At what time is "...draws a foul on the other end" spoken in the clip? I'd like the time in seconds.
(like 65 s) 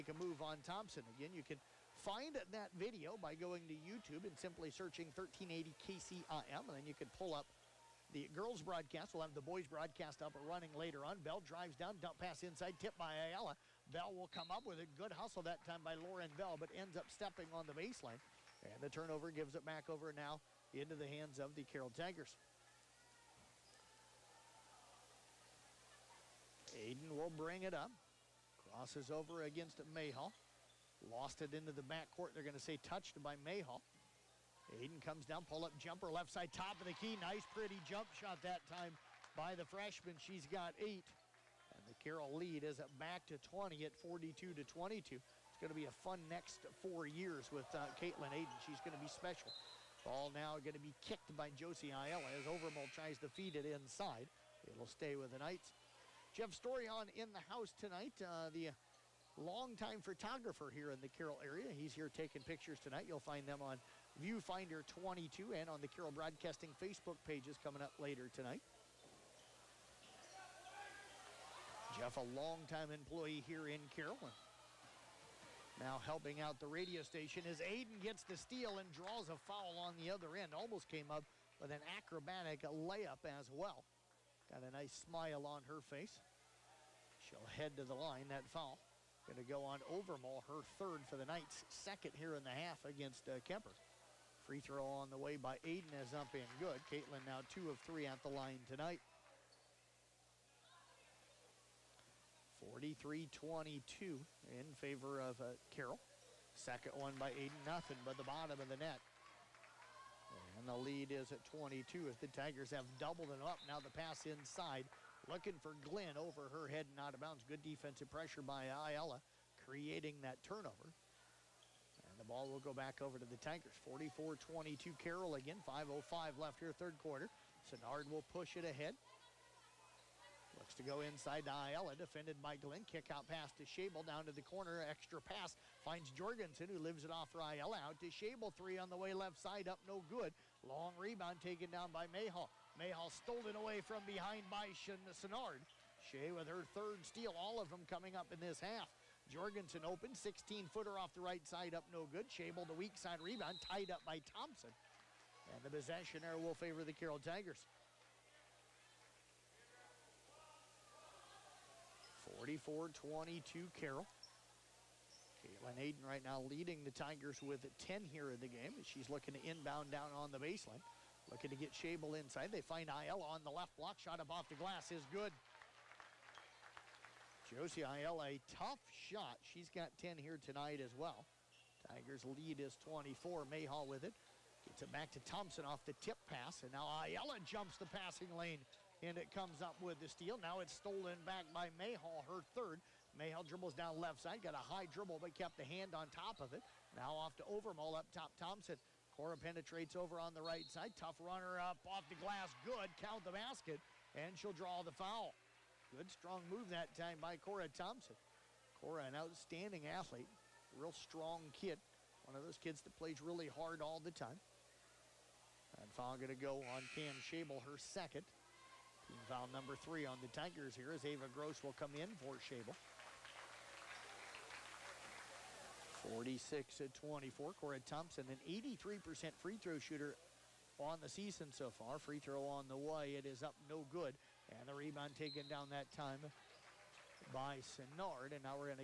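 78 s.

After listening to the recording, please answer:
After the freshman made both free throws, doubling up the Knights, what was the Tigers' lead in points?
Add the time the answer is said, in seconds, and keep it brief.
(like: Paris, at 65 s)
22, at 110 s.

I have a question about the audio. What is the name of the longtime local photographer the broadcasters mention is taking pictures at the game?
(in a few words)
Jeff Story.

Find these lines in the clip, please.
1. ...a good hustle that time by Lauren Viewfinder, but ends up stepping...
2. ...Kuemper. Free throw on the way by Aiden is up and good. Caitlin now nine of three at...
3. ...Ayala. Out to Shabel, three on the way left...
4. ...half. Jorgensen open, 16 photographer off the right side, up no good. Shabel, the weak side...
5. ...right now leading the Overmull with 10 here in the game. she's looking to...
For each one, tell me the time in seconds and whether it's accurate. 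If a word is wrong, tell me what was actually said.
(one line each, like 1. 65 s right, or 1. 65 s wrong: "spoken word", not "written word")
1. 14 s wrong: "Bell", not "Viewfinder"
2. 93 s wrong: "two", not "nine"
3. 137 s right
4. 148 s wrong: "footer", not "photographer"
5. 166 s wrong: "Tigers", not "Overmull".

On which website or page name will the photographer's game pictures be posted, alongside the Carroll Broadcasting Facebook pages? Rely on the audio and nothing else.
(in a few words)
Viewfinder 22.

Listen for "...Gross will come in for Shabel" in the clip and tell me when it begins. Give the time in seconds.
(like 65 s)
221 s.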